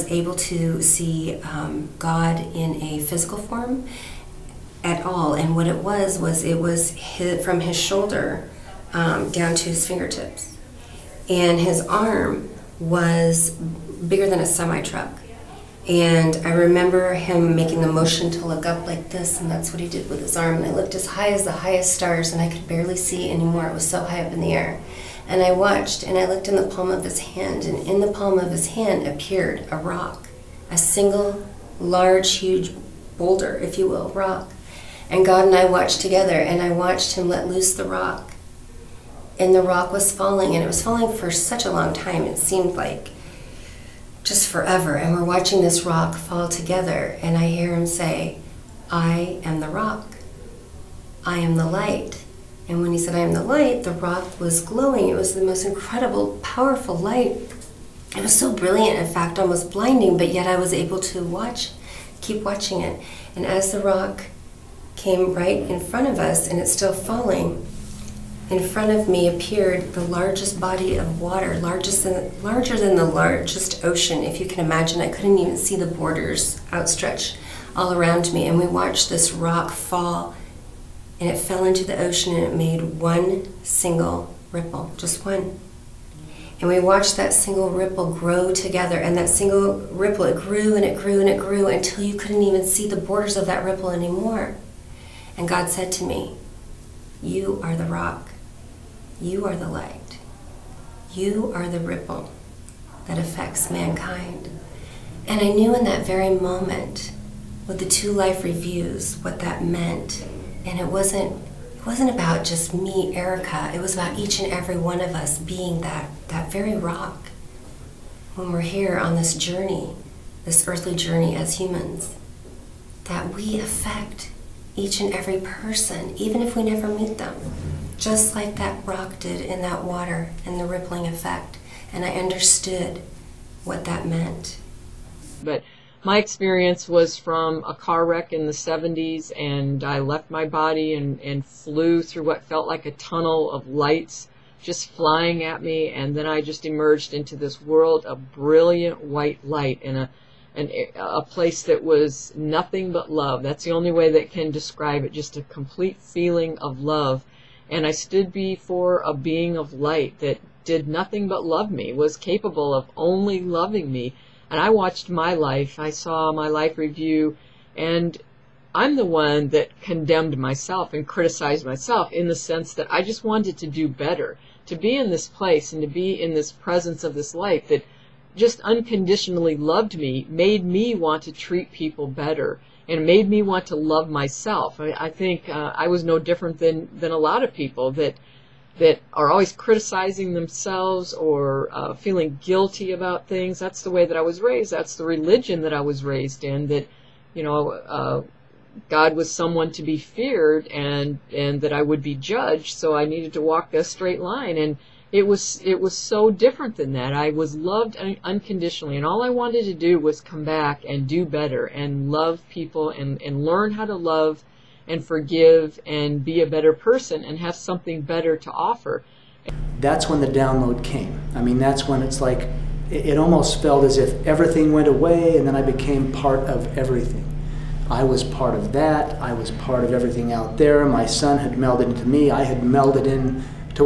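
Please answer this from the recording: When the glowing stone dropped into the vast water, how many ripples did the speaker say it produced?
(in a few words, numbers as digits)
1.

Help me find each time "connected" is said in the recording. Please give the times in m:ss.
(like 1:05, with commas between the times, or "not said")
not said.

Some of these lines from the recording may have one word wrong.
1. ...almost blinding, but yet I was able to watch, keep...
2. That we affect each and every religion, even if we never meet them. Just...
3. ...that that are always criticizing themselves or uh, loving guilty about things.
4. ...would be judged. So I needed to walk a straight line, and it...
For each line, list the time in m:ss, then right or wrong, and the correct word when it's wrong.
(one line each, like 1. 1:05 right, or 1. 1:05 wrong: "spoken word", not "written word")
1. 0:59 right
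2. 2:03 wrong: "person", not "religion"
3. 3:07 wrong: "feeling", not "loving"
4. 3:21 right.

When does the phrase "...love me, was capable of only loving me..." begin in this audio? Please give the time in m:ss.
2:41.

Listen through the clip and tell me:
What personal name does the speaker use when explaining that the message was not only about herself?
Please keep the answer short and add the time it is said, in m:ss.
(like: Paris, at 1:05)
Erica, at 1:53.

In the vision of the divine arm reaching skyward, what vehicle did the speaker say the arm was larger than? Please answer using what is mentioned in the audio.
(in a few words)
A semi truck.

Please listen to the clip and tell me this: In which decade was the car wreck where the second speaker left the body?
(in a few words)
The 70s.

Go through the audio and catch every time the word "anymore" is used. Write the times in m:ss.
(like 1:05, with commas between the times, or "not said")
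0:23, 1:33.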